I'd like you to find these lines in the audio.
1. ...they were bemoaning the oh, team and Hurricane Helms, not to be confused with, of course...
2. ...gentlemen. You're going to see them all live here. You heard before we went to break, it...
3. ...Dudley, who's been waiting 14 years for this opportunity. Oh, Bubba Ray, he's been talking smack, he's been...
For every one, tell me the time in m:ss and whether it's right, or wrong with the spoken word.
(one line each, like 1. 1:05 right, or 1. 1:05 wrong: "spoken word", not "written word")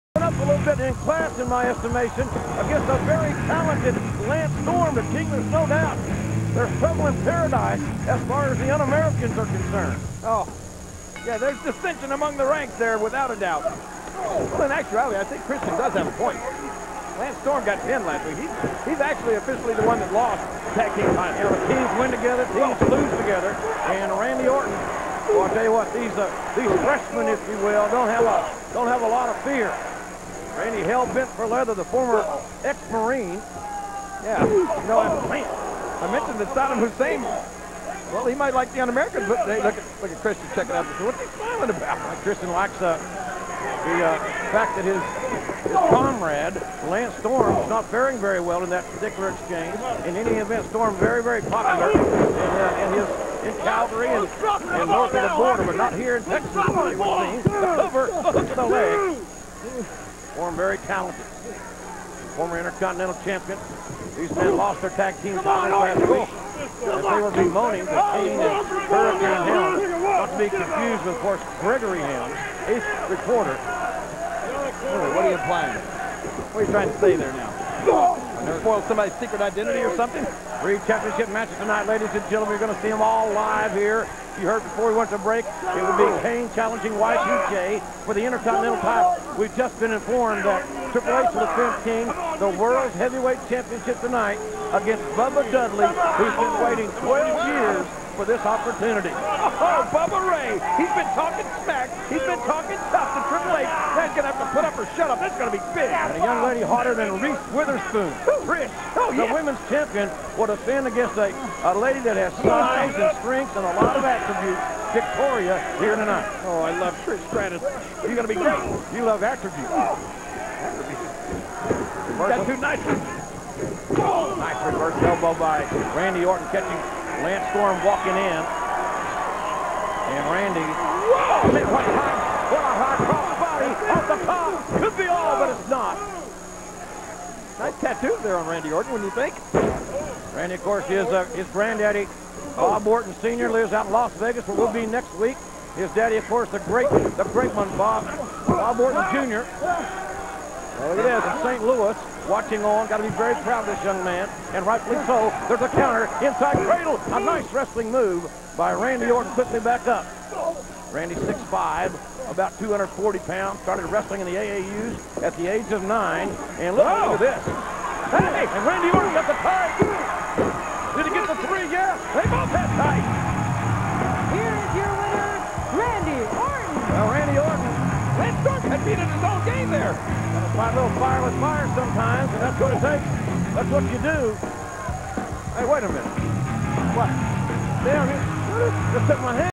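1. 1:07 right
2. 1:22 right
3. 1:35 wrong: "12", not "14".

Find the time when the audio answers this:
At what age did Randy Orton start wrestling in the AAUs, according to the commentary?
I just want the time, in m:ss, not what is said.
2:45.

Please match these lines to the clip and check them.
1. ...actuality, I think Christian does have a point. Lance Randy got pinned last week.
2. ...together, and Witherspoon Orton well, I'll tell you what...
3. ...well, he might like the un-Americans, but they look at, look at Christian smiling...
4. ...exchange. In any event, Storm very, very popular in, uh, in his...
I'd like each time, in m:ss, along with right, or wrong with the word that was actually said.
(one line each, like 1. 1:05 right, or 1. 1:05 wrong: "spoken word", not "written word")
1. 0:14 wrong: "Storm", not "Randy"
2. 0:23 wrong: "Randy", not "Witherspoon"
3. 0:38 wrong: "checking", not "smiling"
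4. 0:49 right.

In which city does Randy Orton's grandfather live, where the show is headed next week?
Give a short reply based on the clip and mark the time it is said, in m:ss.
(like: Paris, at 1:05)
Las Vegas, at 2:23.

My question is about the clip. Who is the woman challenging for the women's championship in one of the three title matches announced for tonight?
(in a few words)
Victoria.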